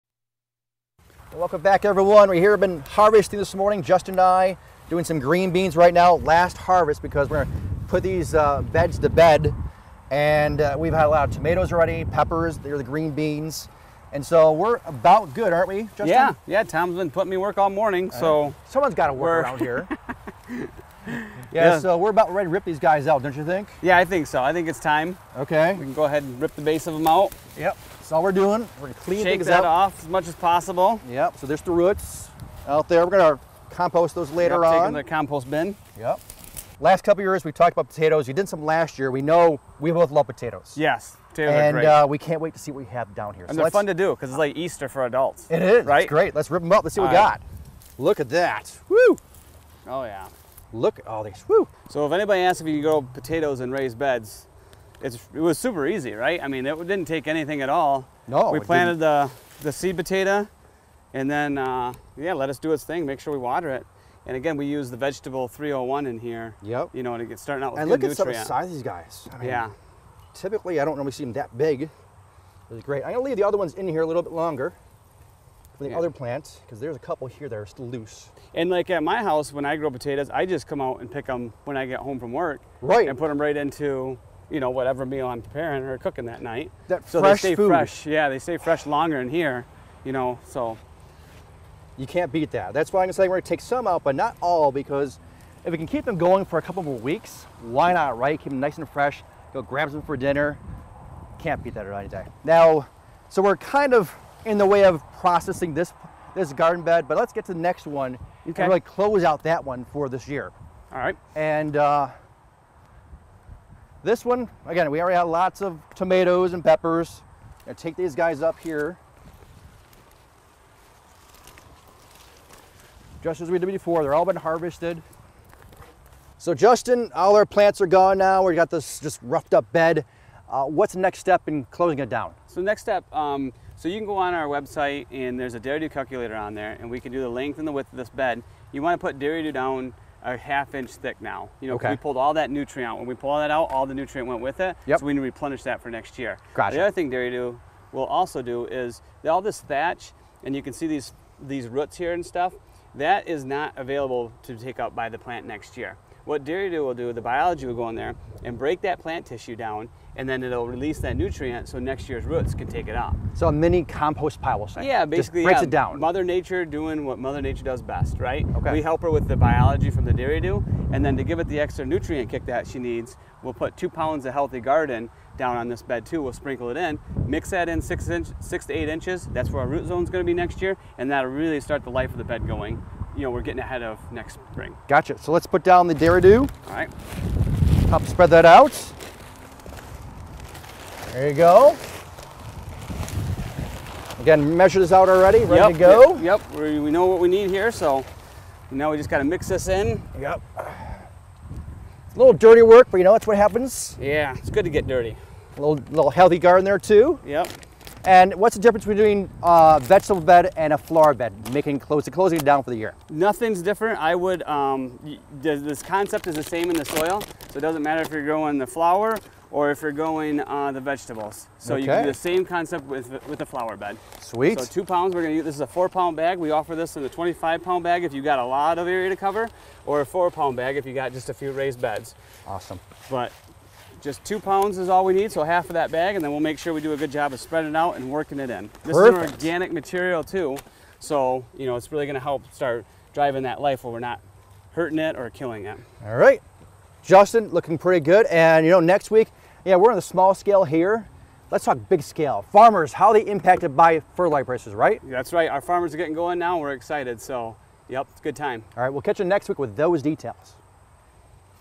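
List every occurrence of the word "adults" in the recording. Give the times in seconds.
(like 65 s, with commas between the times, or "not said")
45 s.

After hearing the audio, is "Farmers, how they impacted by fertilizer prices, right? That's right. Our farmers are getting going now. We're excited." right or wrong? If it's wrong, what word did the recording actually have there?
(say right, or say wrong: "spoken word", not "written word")
right.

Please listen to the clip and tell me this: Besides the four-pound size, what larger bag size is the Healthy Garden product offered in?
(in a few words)
25 pounds.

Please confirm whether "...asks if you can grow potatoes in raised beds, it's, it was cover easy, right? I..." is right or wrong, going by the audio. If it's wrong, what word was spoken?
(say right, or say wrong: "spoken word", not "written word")
wrong: "super", not "cover".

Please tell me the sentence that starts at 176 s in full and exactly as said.
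We'll sprinkle it in, mix that in six, inch, six to eight inches.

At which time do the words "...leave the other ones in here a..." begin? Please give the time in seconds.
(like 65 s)
73 s.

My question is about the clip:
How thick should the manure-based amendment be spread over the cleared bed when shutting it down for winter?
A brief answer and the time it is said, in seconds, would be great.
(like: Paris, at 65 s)
half inch, at 140 s.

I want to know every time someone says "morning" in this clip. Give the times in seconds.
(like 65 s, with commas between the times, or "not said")
3 s, 17 s.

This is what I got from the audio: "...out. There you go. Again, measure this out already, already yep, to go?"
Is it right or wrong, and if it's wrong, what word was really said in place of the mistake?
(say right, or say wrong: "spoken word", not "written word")
wrong: "ready", not "already".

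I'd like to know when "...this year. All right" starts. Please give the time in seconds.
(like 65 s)
110 s.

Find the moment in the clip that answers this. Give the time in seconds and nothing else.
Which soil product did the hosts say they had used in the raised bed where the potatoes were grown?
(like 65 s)
64 s.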